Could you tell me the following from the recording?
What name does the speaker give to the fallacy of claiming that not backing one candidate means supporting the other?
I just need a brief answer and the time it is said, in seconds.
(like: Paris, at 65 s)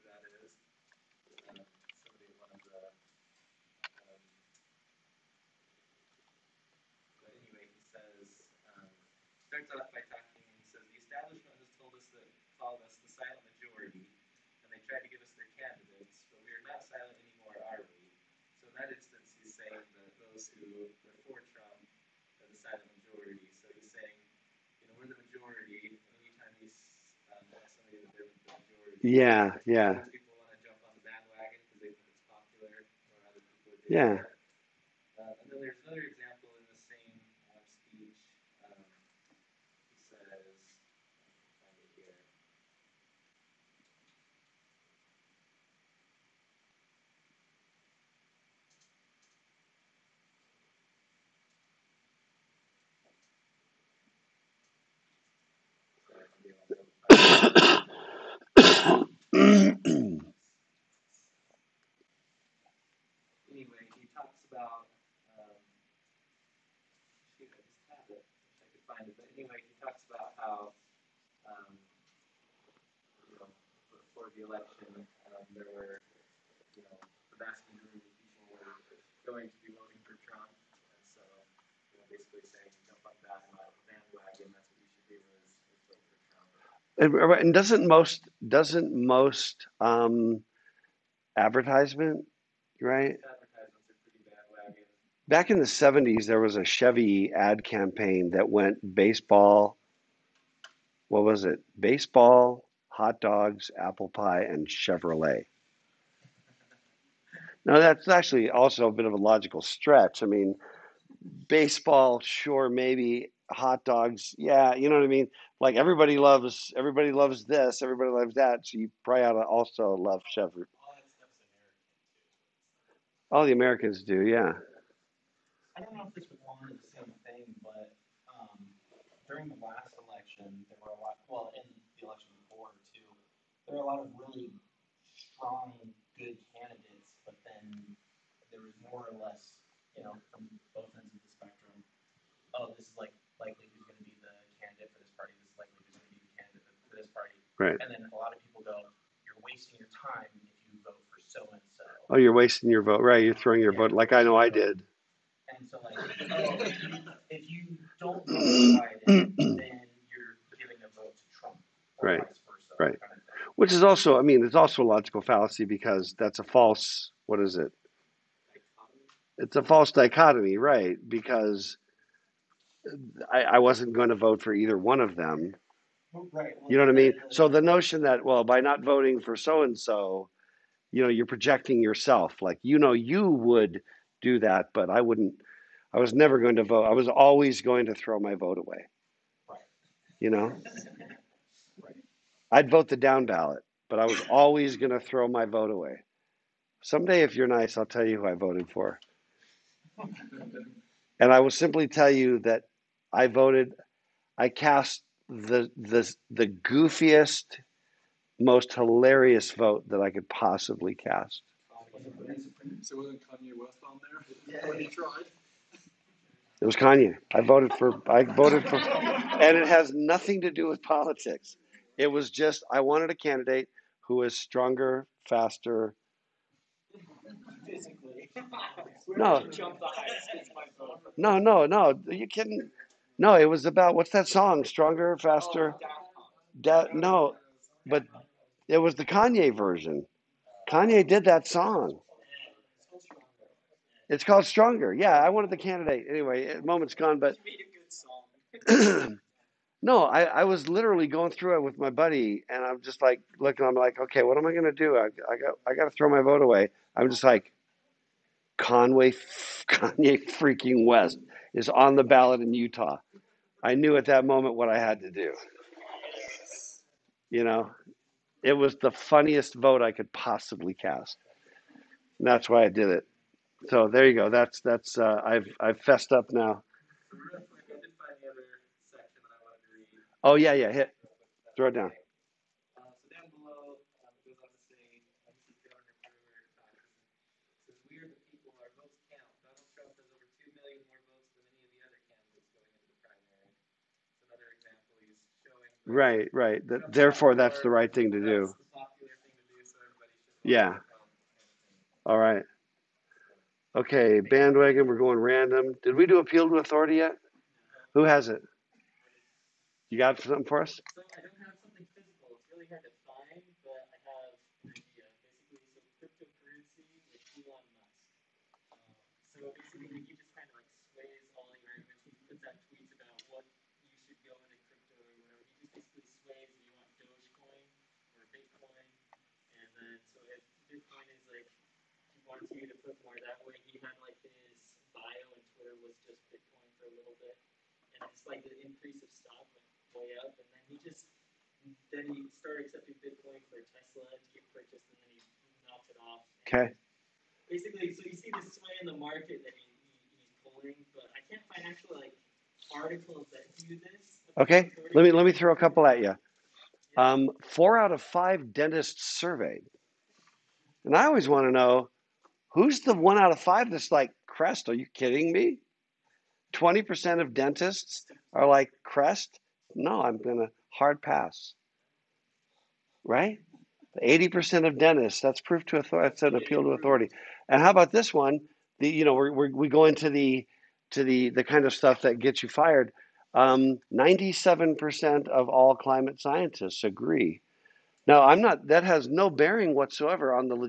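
false dichotomy, at 169 s.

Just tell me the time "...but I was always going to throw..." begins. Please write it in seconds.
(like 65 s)
193 s.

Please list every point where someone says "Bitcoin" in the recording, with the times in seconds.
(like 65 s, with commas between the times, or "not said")
336 s, 342 s.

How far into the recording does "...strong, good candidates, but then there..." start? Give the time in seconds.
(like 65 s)
135 s.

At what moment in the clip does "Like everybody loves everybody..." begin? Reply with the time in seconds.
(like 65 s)
115 s.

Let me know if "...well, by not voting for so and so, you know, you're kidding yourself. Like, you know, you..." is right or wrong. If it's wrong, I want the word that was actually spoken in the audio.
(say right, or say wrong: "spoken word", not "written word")
wrong: "projecting", not "kidding".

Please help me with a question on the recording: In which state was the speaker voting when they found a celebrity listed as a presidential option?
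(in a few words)
Utah.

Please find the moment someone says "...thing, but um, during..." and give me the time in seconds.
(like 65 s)
127 s.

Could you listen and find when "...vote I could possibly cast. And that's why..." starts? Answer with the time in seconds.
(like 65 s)
269 s.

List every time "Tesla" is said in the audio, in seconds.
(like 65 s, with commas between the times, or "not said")
343 s.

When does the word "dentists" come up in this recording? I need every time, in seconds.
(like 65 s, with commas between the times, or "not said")
358 s, 367 s, 374 s.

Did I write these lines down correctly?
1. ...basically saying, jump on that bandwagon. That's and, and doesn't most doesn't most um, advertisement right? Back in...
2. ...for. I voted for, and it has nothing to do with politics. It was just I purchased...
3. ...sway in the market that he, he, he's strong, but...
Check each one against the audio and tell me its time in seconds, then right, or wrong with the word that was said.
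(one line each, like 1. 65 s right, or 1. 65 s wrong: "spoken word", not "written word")
1. 82 s right
2. 217 s wrong: "wanted", not "purchased"
3. 348 s wrong: "pulling", not "strong".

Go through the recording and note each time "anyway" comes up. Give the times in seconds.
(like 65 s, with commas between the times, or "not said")
59 s, 69 s, 246 s.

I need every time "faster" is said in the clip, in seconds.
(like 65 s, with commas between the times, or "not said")
225 s, 235 s.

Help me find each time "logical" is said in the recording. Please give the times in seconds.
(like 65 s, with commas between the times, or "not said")
109 s, 164 s.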